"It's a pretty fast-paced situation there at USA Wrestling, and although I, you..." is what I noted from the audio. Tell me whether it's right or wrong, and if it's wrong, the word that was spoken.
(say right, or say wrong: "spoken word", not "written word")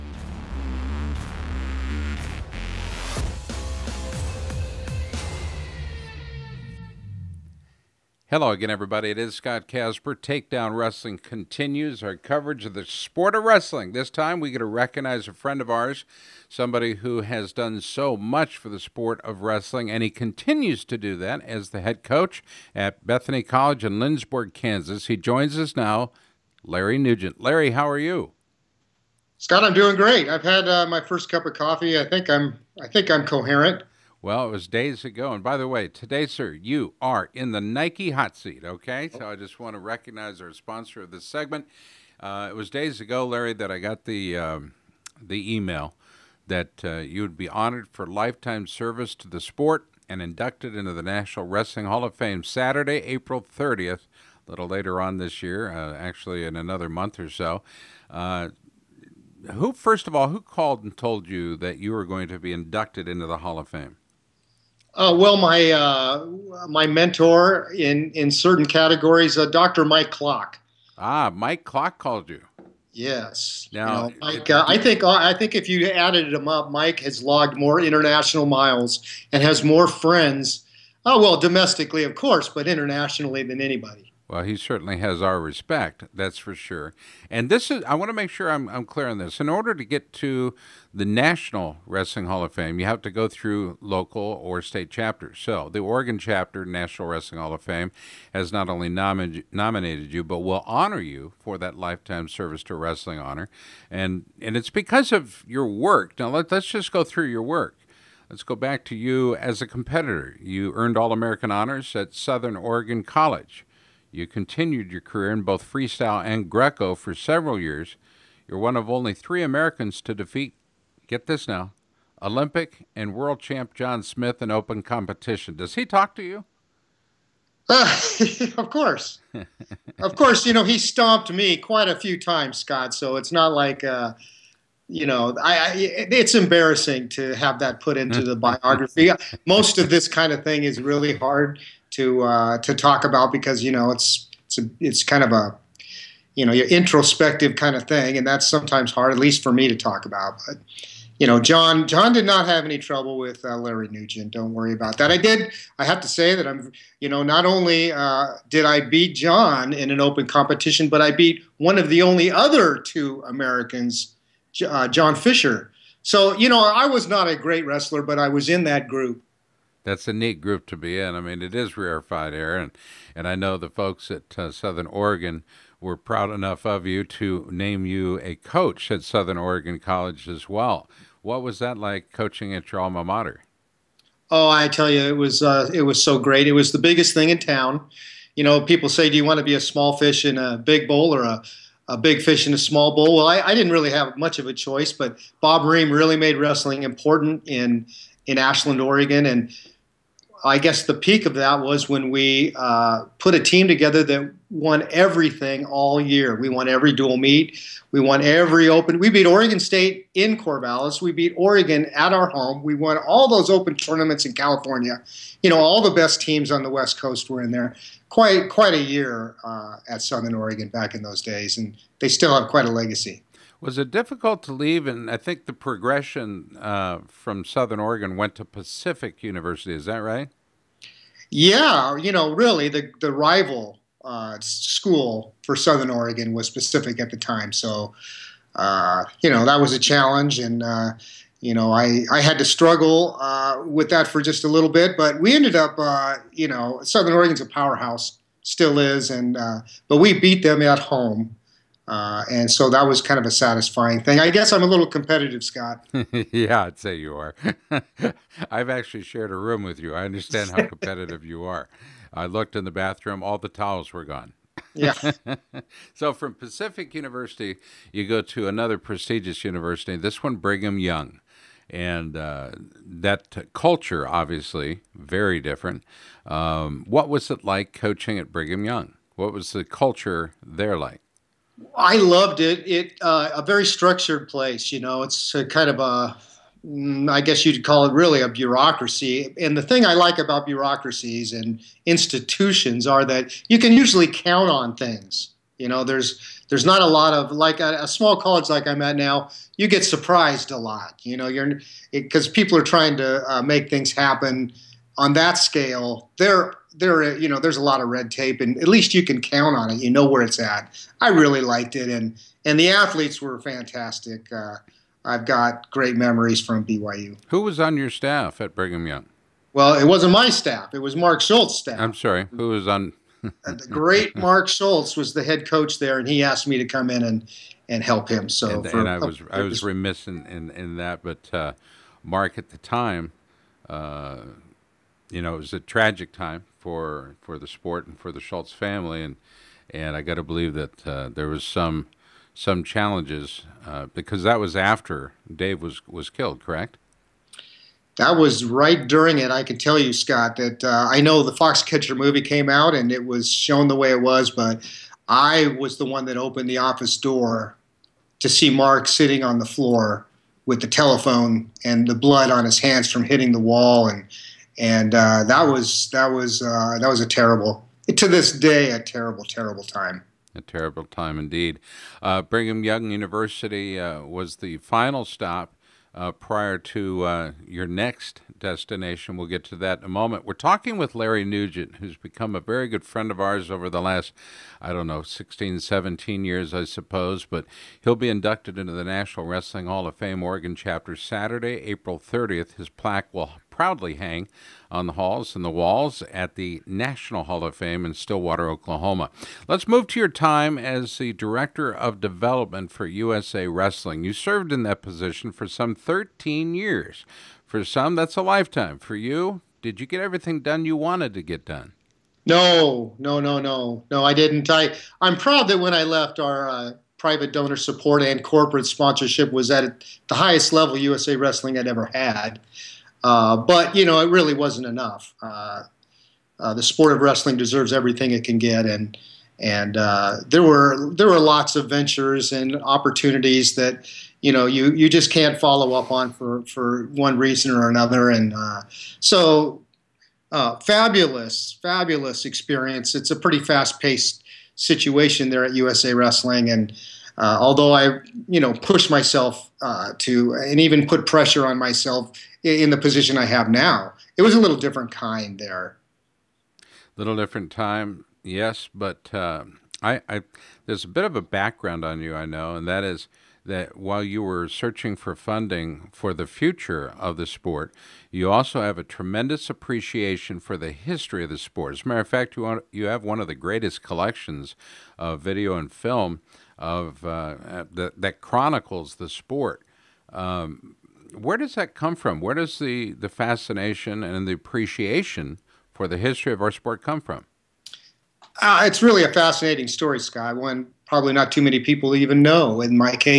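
right.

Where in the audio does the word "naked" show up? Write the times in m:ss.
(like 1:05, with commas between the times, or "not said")
not said.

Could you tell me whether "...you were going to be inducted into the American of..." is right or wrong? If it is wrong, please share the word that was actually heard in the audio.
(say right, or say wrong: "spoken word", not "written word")
wrong: "Hall", not "American".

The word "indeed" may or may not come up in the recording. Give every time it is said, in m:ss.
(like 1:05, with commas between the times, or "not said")
6:11.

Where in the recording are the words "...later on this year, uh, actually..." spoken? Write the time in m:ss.
0:54.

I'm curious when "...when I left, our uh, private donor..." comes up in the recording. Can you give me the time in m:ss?
6:55.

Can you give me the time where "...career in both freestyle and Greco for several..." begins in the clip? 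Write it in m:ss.
1:55.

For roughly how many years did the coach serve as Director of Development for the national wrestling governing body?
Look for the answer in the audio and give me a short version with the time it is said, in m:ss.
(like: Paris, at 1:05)
13, at 6:45.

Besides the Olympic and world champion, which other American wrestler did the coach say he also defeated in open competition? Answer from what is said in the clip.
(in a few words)
John Fisher.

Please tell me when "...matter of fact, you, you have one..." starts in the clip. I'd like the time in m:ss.
7:51.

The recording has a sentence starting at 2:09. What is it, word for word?
of course, you know, he stomped me quite a few times, Scott, so it's not like.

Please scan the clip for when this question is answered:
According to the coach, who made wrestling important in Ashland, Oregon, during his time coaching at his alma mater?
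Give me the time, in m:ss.
3:15.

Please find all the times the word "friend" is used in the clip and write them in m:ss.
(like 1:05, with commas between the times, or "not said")
0:15, 1:19, 6:22.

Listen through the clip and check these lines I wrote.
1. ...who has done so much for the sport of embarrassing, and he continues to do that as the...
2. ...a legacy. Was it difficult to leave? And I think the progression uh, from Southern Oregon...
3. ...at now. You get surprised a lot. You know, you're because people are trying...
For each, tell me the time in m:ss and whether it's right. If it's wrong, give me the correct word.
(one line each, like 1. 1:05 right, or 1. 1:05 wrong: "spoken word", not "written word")
1. 0:16 wrong: "wrestling", not "embarrassing"
2. 3:42 right
3. 4:58 right.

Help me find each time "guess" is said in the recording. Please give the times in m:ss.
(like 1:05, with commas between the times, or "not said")
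3:20, 4:14, 4:47.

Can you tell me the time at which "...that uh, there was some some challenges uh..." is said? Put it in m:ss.
5:40.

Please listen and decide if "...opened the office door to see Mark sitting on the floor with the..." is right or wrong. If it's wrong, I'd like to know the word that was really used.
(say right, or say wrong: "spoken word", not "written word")
right.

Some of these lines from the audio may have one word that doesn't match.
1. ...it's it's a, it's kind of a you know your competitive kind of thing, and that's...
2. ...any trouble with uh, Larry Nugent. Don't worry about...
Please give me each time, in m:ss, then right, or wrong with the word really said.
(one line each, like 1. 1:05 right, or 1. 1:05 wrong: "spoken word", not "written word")
1. 2:23 wrong: "introspective", not "competitive"
2. 2:32 right.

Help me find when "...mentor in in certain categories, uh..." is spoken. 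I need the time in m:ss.
1:06.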